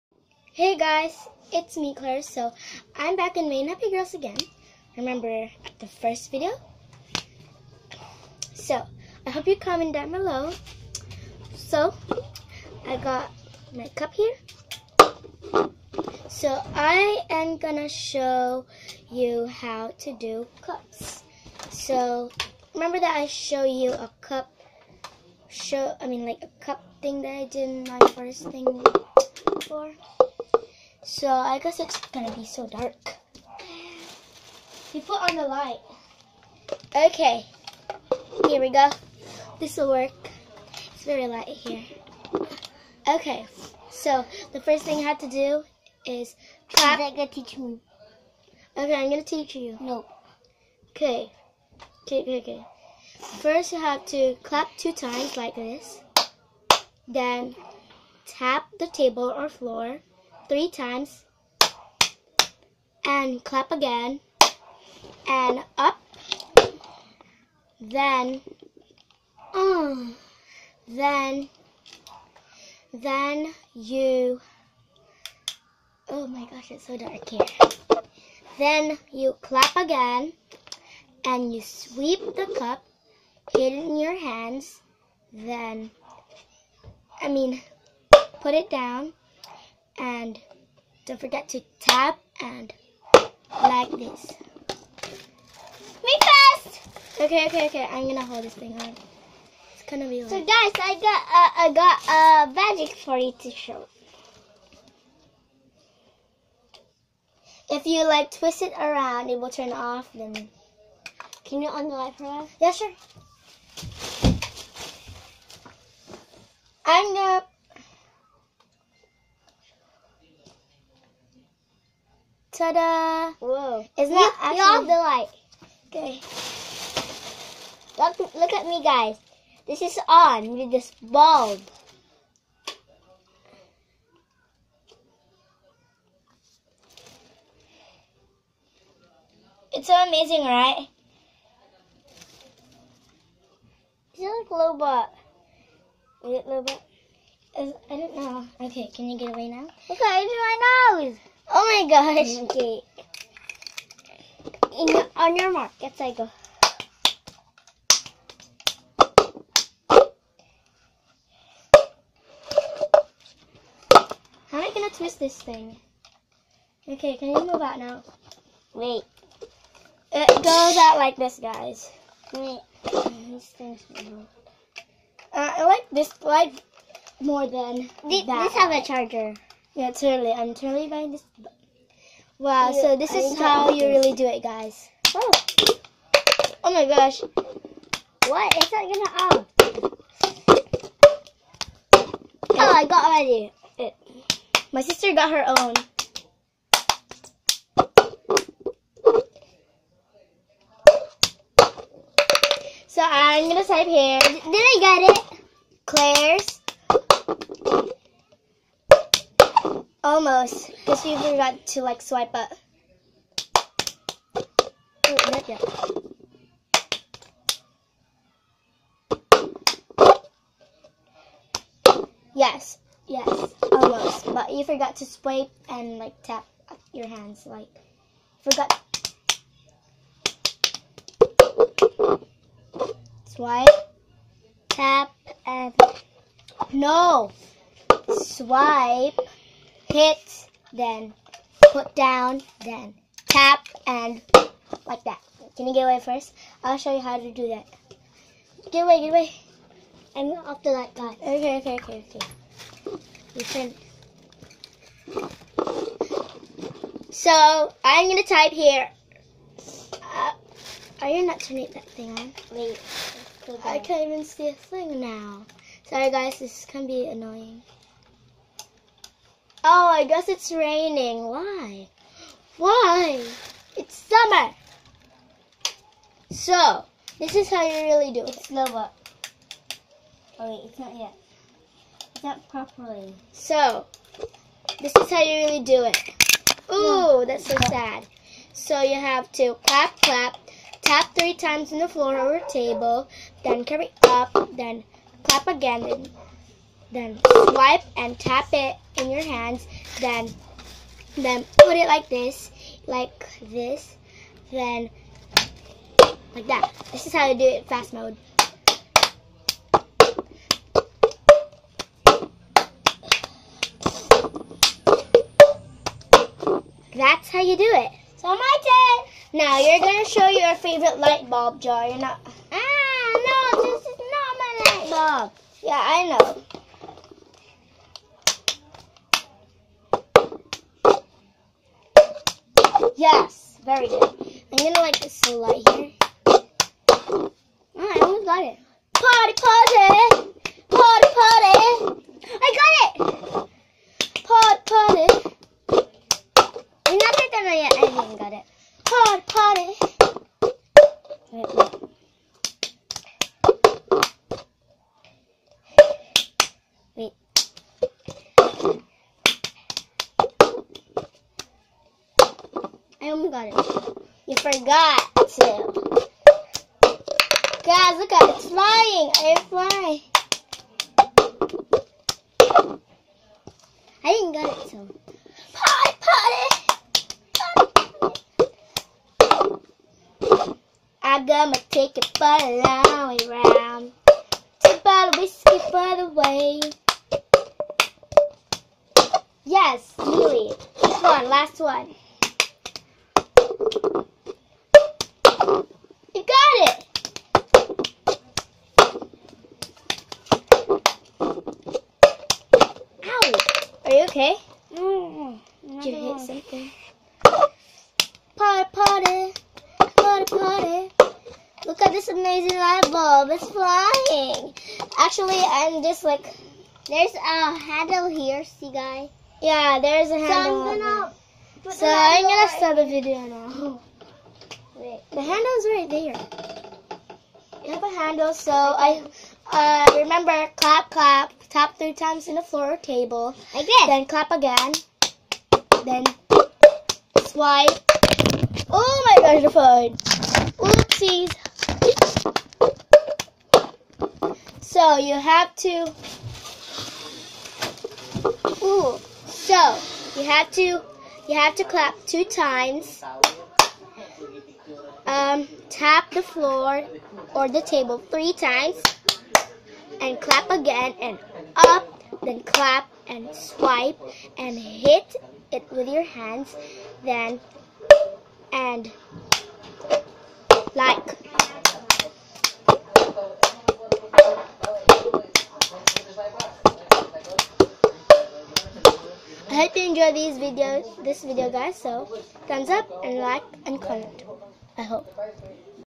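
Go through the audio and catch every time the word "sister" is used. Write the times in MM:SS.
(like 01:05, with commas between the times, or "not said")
03:14.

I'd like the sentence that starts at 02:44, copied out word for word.
How am I gonna twist this thing?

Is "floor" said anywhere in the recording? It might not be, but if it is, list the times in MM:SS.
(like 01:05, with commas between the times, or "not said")
00:59, 04:51, 07:12, 07:36.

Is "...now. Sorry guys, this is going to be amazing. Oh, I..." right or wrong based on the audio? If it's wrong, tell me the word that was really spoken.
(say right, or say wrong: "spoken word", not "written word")
wrong: "annoying", not "amazing".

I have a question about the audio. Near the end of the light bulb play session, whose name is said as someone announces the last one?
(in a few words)
Lily.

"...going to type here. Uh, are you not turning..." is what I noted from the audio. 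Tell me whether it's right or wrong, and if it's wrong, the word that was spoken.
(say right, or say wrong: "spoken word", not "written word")
right.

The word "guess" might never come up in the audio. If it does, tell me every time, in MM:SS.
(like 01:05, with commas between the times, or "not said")
00:31, 04:30.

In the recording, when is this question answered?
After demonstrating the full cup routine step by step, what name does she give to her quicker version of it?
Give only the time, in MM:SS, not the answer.
05:07.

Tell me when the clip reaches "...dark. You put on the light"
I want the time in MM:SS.
00:32.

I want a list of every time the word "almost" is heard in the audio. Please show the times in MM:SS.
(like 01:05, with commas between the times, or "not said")
03:43, 05:37.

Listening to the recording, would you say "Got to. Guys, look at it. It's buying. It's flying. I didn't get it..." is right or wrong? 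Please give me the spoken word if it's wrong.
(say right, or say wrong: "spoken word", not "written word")
wrong: "flying", not "buying".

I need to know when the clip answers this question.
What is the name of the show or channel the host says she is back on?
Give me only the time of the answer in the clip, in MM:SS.
00:03.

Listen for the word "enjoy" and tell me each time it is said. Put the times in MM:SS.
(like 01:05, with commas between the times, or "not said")
08:00.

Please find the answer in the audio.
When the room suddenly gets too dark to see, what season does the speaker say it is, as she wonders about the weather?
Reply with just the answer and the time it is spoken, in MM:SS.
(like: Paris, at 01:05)
summer, at 04:33.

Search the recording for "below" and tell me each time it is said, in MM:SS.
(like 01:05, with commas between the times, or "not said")
00:10.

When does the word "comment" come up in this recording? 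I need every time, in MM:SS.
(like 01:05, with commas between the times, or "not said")
00:09, 08:03.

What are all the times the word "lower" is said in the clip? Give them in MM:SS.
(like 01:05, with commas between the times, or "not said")
04:38.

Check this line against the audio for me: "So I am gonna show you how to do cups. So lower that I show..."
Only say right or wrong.
wrong.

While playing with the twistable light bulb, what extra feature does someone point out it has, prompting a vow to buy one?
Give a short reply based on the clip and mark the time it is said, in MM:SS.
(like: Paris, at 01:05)
a charger, at 02:58.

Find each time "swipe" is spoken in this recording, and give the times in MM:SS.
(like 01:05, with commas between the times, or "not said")
03:32, 03:45, 03:53, 03:58, 04:57, 07:17, 07:43.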